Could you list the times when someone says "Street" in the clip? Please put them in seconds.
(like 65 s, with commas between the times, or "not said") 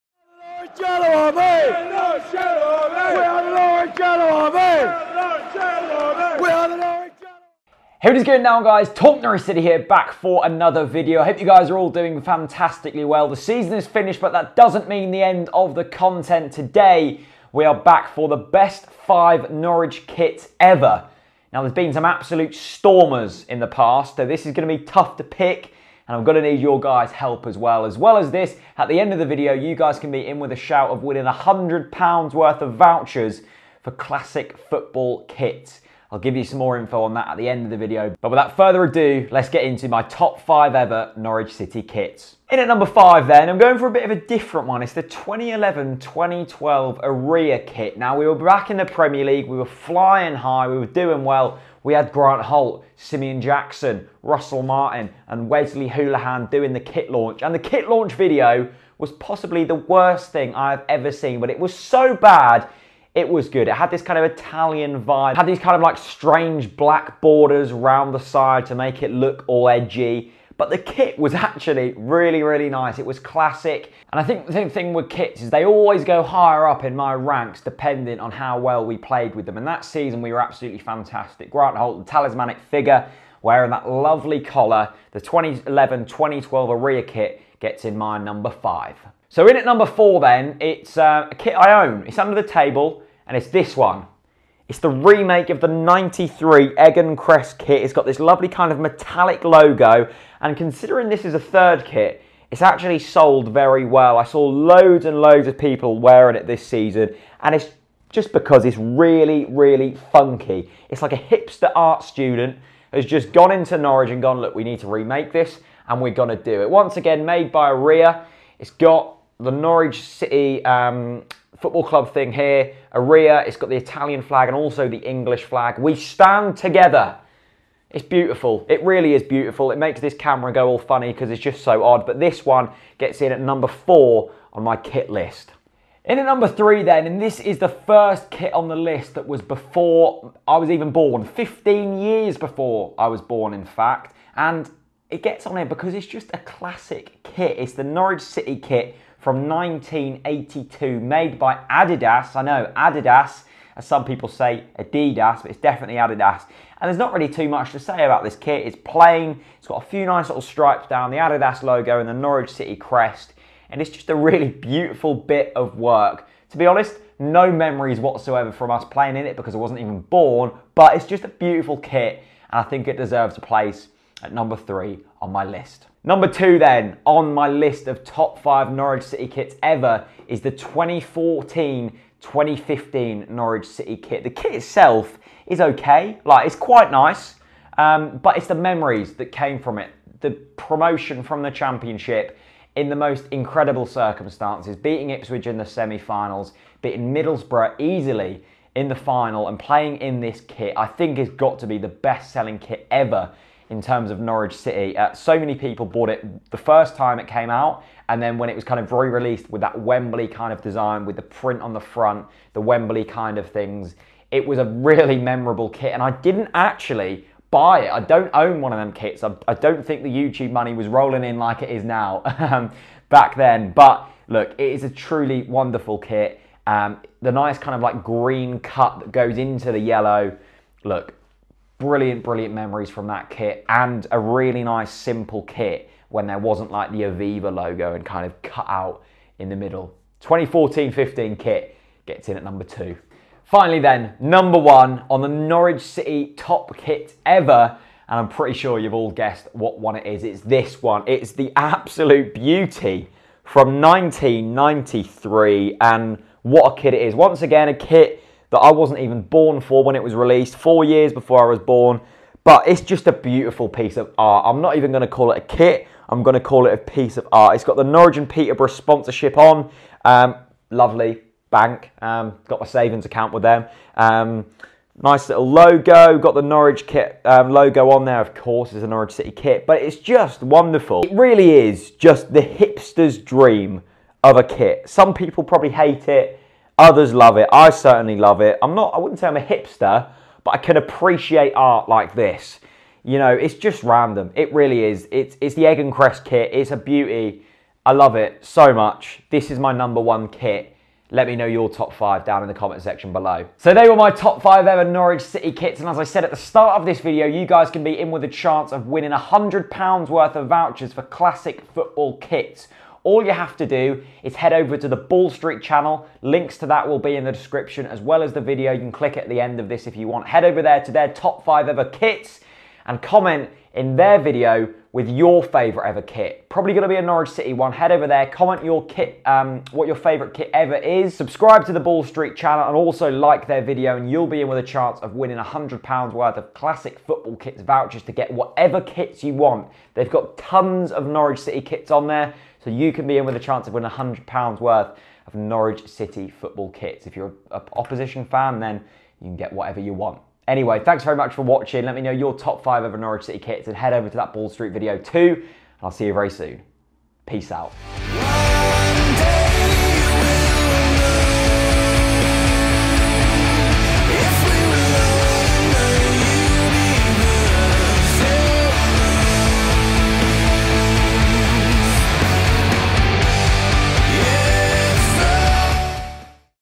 315 s, 332 s, 354 s.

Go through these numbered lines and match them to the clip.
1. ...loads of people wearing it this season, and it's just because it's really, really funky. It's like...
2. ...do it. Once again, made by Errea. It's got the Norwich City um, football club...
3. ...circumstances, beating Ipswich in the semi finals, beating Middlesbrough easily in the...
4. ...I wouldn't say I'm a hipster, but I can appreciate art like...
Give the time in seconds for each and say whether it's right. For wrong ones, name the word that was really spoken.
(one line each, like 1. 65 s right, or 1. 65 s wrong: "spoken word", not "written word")
1. 105 s right
2. 116 s right
3. 193 s right
4. 288 s right.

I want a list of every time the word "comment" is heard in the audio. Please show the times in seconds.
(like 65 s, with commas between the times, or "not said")
302 s, 323 s, 328 s.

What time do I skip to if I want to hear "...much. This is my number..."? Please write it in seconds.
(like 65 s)
298 s.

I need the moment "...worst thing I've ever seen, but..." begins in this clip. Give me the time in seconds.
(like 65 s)
59 s.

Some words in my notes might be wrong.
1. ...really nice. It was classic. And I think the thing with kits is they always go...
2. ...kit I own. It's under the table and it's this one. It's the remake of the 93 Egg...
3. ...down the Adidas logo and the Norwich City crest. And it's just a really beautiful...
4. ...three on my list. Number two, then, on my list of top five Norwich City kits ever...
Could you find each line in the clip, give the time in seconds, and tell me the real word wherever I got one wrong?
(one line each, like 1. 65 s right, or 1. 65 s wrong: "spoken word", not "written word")
1. 72 s right
2. 91 s right
3. 160 s right
4. 174 s right.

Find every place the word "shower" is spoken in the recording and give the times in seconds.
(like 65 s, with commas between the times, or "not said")
not said.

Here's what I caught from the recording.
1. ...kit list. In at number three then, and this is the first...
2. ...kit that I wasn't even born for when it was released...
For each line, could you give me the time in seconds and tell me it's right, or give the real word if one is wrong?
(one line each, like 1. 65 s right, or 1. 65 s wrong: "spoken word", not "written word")
1. 134 s right
2. 257 s right.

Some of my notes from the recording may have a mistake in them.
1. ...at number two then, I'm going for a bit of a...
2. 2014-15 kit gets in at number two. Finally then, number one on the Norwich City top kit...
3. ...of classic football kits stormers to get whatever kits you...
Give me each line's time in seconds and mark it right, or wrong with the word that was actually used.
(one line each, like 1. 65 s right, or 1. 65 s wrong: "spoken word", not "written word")
1. 42 s wrong: "five", not "two"
2. 240 s right
3. 336 s wrong: "vouchers", not "stormers".